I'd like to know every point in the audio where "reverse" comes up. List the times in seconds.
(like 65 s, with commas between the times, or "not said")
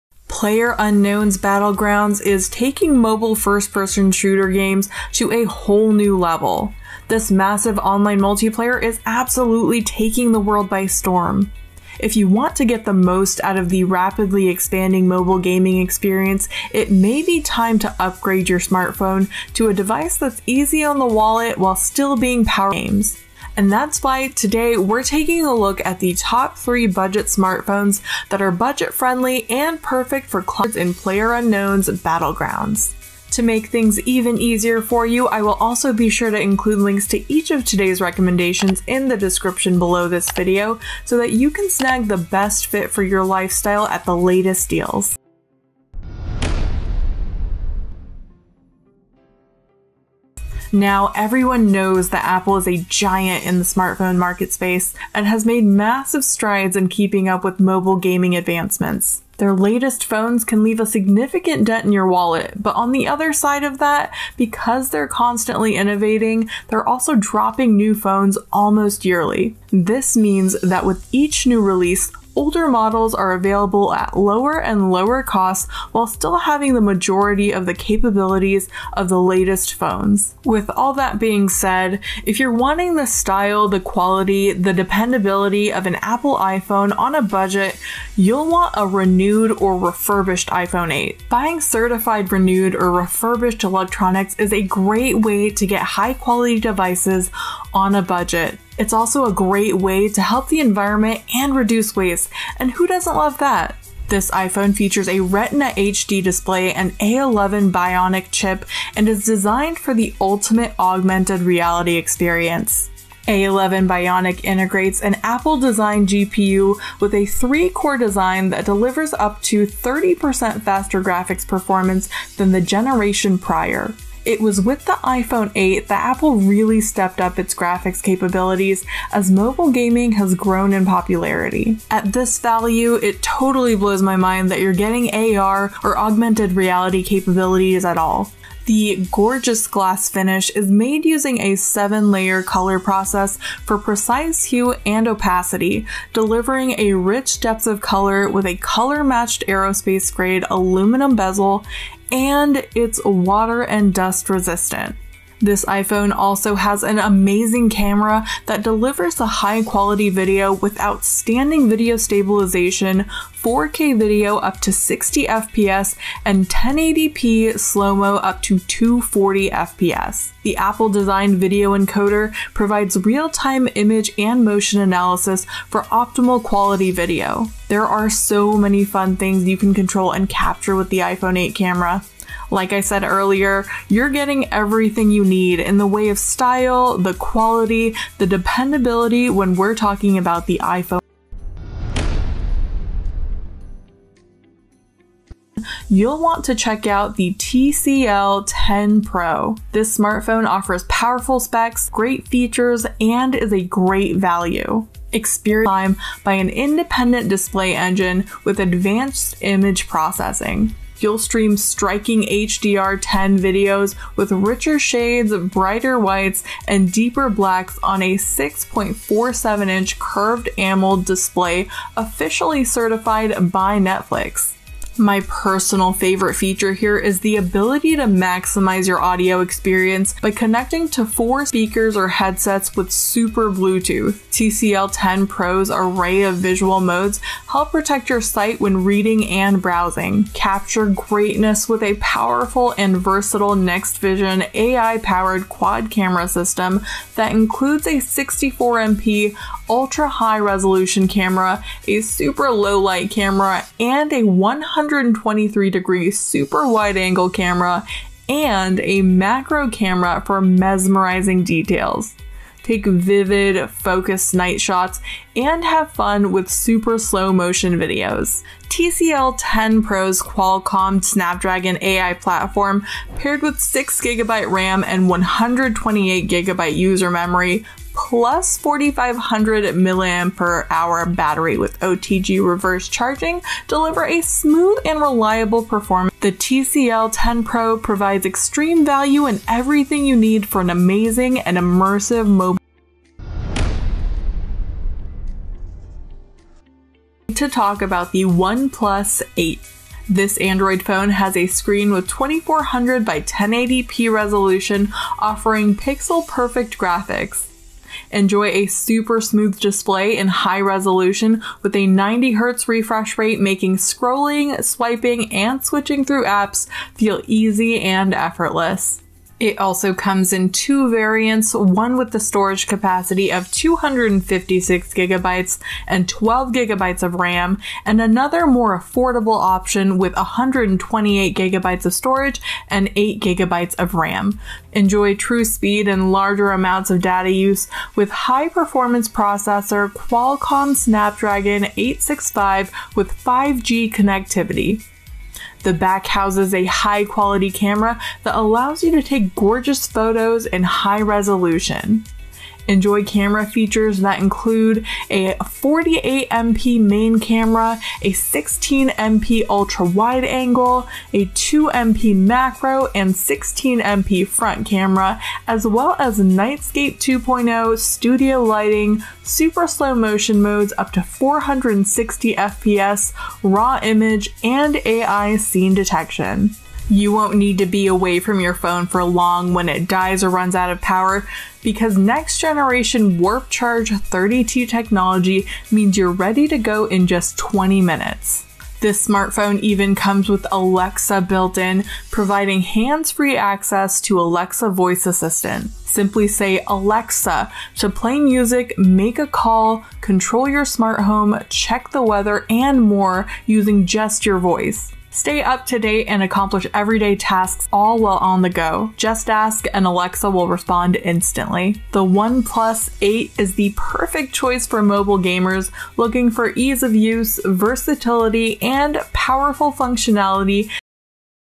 282 s.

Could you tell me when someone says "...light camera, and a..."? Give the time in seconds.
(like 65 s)
252 s.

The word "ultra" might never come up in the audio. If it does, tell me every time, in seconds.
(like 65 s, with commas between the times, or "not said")
249 s, 359 s.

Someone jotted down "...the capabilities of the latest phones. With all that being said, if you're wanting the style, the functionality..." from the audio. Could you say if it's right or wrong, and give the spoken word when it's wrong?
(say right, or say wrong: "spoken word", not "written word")
wrong: "quality", not "functionality".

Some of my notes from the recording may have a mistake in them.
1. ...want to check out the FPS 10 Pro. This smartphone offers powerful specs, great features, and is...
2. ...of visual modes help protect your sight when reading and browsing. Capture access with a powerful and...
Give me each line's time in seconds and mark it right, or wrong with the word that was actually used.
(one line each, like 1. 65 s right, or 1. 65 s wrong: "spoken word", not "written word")
1. 196 s wrong: "TCL", not "FPS"
2. 236 s wrong: "greatness", not "access".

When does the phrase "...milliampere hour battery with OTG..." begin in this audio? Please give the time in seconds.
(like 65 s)
279 s.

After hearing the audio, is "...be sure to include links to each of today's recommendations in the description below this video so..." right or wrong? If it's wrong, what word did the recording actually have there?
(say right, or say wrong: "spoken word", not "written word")
right.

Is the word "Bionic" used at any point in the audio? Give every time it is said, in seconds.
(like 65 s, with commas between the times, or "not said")
107 s, 113 s.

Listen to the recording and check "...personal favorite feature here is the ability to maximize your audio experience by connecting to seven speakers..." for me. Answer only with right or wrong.
wrong.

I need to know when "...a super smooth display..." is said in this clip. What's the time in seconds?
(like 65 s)
308 s.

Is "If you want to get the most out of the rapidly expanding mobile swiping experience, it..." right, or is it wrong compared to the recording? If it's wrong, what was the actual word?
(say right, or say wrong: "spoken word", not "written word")
wrong: "gaming", not "swiping".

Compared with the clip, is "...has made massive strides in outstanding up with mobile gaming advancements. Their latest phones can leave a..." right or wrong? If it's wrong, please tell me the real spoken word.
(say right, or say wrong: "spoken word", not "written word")
wrong: "keeping", not "outstanding".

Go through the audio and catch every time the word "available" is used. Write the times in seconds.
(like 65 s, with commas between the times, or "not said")
73 s.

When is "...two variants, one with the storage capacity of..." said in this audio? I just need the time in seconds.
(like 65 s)
320 s.